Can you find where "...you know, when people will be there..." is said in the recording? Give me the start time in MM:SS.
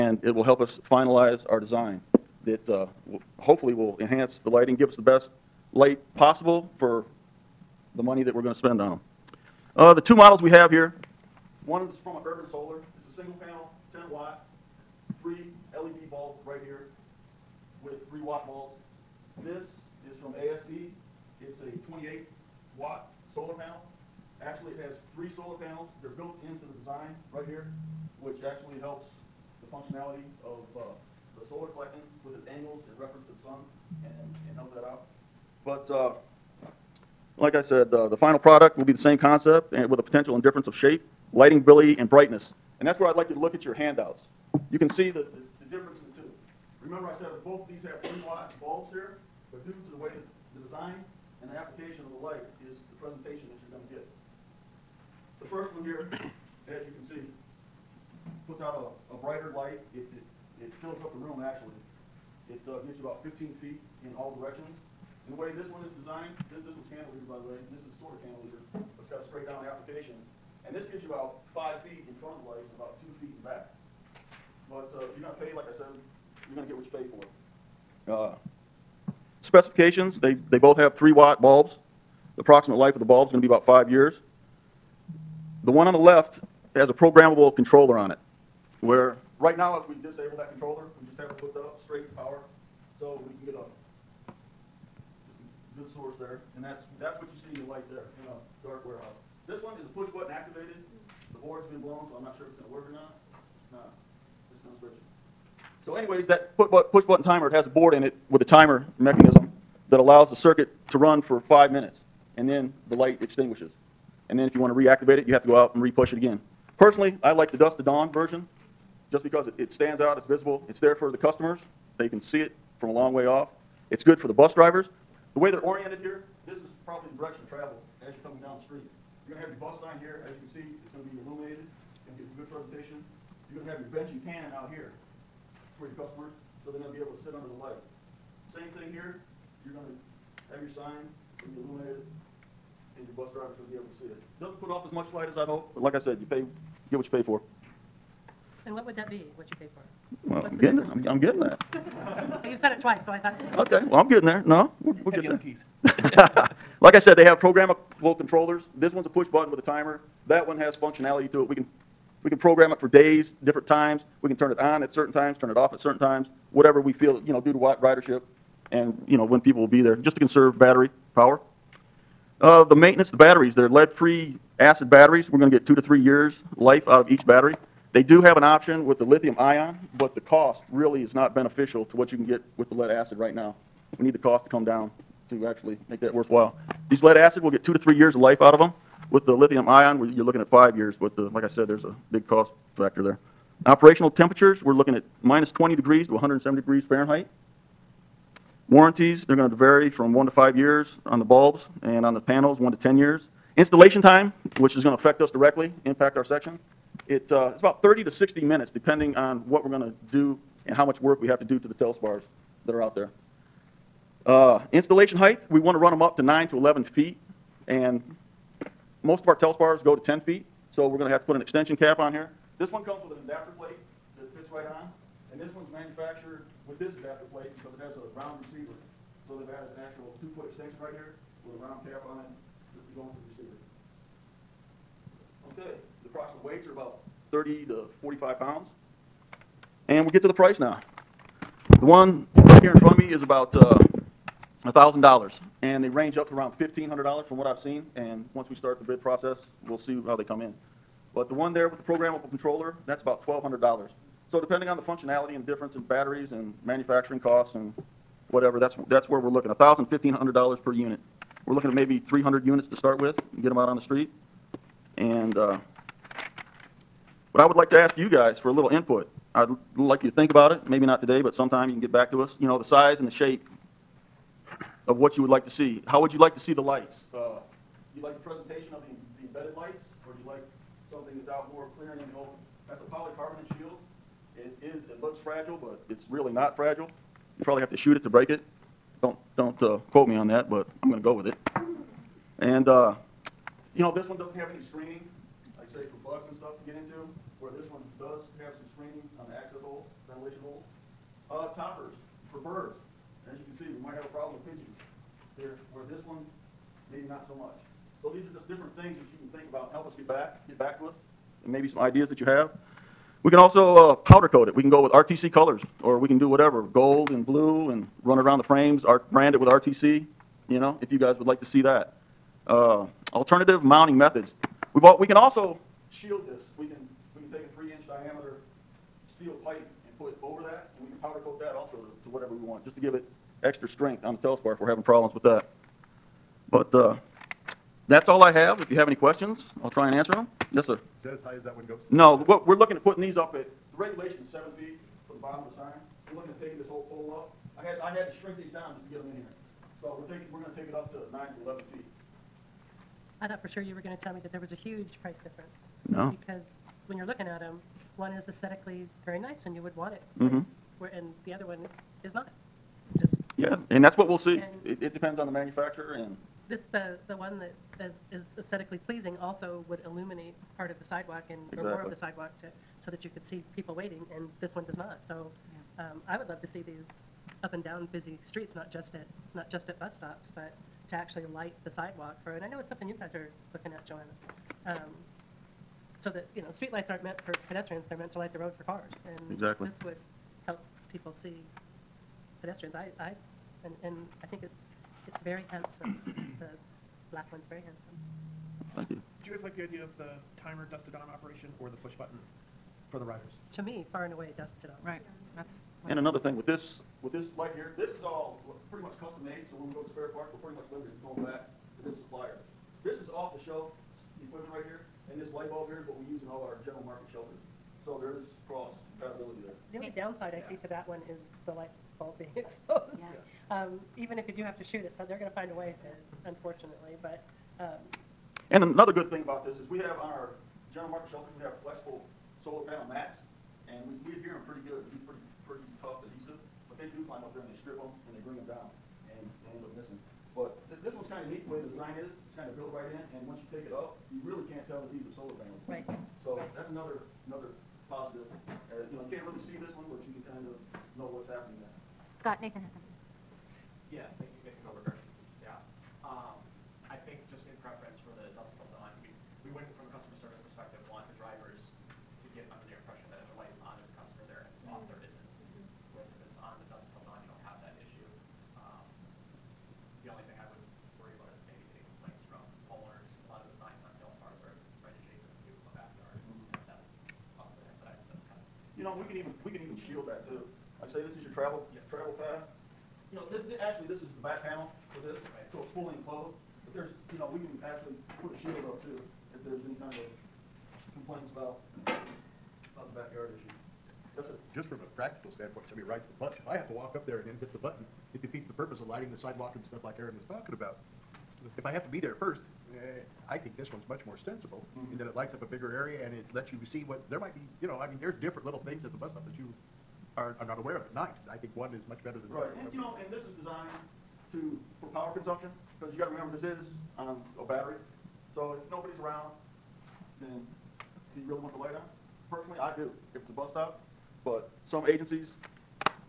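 02:49.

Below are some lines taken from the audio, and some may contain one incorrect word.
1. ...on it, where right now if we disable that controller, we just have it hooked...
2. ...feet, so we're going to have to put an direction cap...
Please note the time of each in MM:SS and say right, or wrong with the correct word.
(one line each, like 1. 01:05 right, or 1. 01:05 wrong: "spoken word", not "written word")
1. 01:27 right
2. 03:40 wrong: "extension", not "direction".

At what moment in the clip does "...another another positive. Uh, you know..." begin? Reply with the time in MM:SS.
07:26.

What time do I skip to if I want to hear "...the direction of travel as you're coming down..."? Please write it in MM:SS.
02:07.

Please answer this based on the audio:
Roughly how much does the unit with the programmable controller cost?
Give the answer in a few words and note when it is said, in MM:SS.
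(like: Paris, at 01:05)
$1,200, at 04:13.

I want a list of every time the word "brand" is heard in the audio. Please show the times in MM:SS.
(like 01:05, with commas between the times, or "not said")
05:19.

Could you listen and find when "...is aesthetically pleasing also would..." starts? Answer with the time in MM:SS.
06:08.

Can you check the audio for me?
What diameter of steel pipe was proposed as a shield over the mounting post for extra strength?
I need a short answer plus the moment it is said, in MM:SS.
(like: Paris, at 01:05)
3 inches, at 05:27.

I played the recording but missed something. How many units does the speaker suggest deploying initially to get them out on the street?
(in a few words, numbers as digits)
300.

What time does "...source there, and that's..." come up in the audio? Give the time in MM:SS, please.
01:35.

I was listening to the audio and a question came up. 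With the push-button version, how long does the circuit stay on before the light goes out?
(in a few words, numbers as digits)
5 minutes.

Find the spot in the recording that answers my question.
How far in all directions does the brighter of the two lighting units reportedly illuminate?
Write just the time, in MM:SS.
01:03.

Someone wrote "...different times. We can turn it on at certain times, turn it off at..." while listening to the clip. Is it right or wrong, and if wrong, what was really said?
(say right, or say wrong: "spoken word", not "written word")
right.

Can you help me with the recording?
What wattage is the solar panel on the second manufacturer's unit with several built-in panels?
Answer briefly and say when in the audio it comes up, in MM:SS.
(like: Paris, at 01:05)
28 watt, at 00:21.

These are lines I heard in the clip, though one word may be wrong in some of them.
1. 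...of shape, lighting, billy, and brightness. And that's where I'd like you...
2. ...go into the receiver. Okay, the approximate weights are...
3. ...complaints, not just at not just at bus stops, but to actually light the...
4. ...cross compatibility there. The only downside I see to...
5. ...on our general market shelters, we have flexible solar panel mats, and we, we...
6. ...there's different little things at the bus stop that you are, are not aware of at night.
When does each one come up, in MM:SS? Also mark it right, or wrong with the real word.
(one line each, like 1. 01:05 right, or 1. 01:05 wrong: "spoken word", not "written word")
1. 00:40 right
2. 03:52 right
3. 06:18 wrong: "streets", not "complaints"
4. 06:58 right
5. 07:10 right
6. 08:27 right.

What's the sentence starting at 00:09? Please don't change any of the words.
Uh, the two models we have here one is from an urban solar.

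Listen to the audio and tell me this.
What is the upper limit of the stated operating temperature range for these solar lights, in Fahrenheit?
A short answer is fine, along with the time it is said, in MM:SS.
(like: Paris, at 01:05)
170 degrees, at 03:16.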